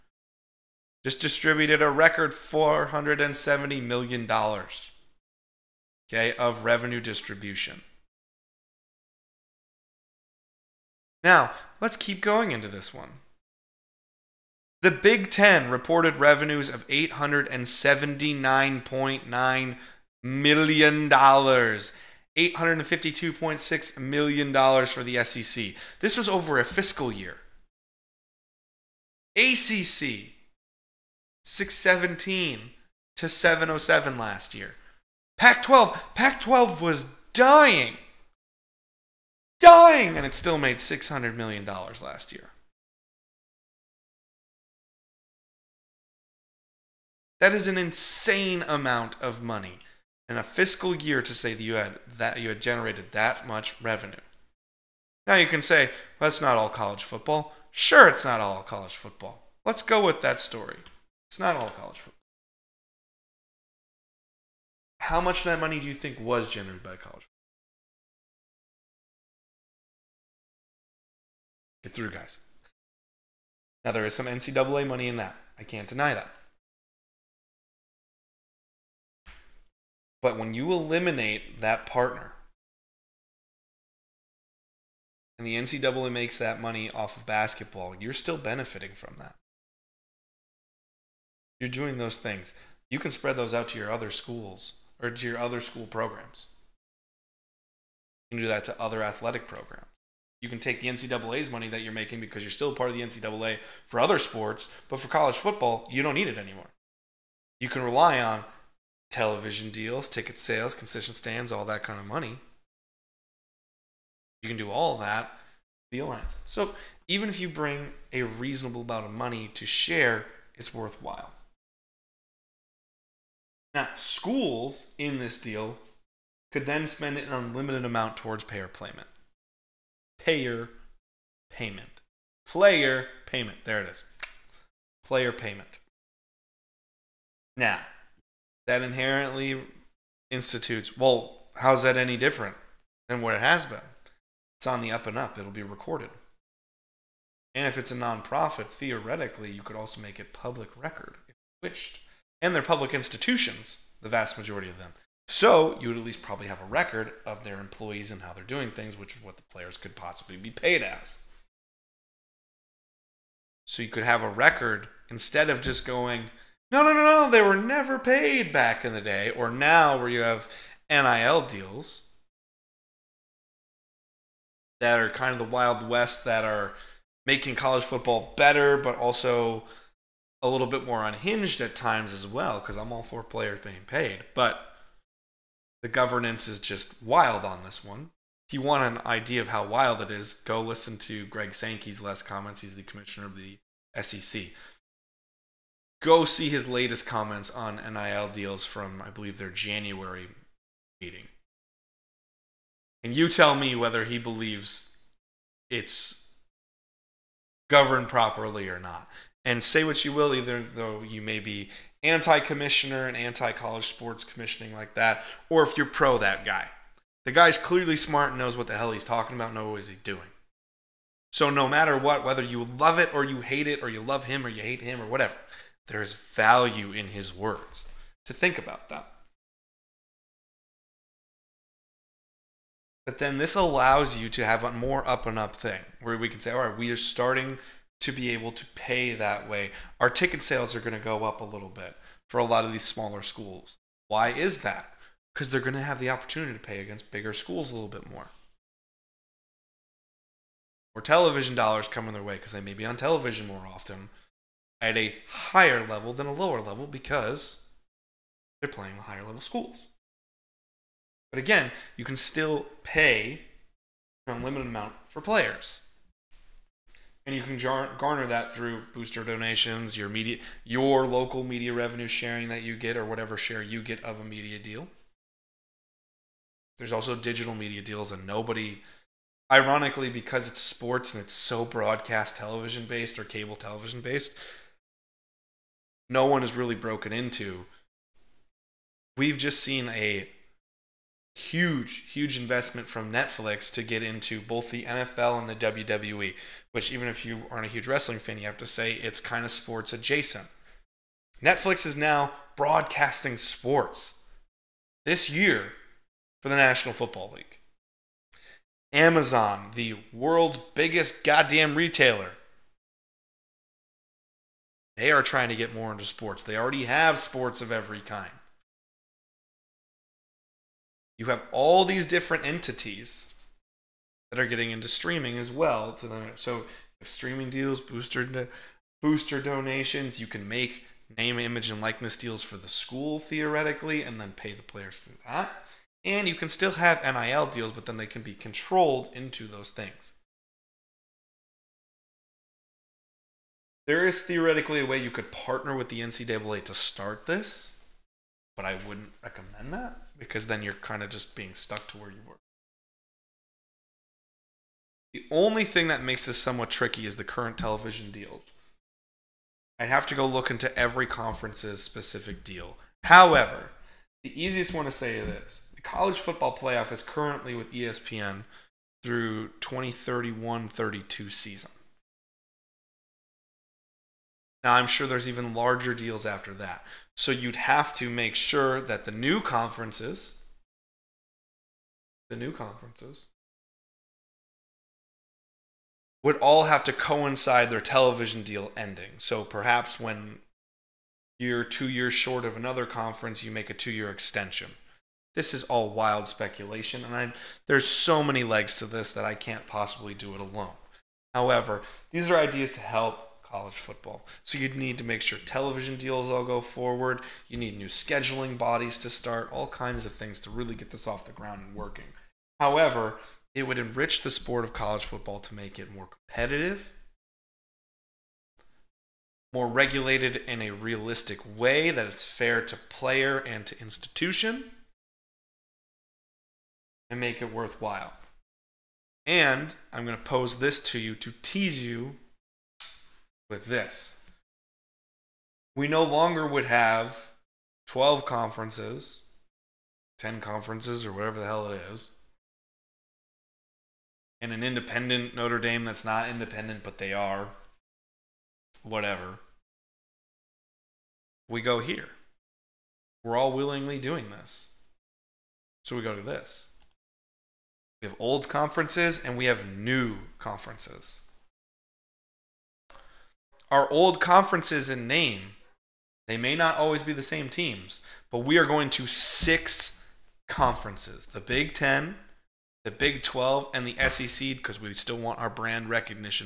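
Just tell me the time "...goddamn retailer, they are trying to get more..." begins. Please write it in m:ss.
5:11.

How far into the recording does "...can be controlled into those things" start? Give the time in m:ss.
5:38.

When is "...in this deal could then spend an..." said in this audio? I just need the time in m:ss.
2:04.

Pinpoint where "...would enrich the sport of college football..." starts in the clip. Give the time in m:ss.
6:53.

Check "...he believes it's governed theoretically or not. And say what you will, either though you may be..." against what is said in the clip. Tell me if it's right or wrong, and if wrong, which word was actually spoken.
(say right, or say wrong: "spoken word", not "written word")
wrong: "properly", not "theoretically".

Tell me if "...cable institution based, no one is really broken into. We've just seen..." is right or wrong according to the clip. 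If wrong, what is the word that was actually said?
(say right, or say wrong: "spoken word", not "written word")
wrong: "television", not "institution".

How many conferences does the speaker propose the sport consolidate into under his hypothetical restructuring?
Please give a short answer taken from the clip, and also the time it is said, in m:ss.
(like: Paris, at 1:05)
6, at 7:49.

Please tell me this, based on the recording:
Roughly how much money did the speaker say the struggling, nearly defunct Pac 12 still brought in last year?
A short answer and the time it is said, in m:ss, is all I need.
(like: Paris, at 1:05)
$600 million, at 0:40.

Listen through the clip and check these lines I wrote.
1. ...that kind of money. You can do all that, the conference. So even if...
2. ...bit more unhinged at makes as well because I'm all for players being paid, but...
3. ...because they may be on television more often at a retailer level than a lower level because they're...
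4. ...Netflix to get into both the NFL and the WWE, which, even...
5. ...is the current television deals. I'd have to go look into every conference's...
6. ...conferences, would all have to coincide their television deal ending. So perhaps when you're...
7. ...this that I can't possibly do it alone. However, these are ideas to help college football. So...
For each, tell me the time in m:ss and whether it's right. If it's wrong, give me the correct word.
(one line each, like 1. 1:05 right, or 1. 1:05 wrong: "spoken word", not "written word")
1. 1:51 wrong: "alliance", not "conference"
2. 3:00 wrong: "times", not "makes"
3. 4:12 wrong: "higher", not "retailer"
4. 4:53 right
5. 5:57 right
6. 6:22 right
7. 6:38 right.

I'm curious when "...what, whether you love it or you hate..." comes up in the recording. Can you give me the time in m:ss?
3:41.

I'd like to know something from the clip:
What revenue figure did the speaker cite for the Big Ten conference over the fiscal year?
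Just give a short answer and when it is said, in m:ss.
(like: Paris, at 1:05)
$879.9 million, at 0:16.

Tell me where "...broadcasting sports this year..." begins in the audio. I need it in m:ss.
5:02.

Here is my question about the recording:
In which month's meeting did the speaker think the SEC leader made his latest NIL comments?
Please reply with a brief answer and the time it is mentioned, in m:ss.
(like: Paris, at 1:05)
January, at 3:19.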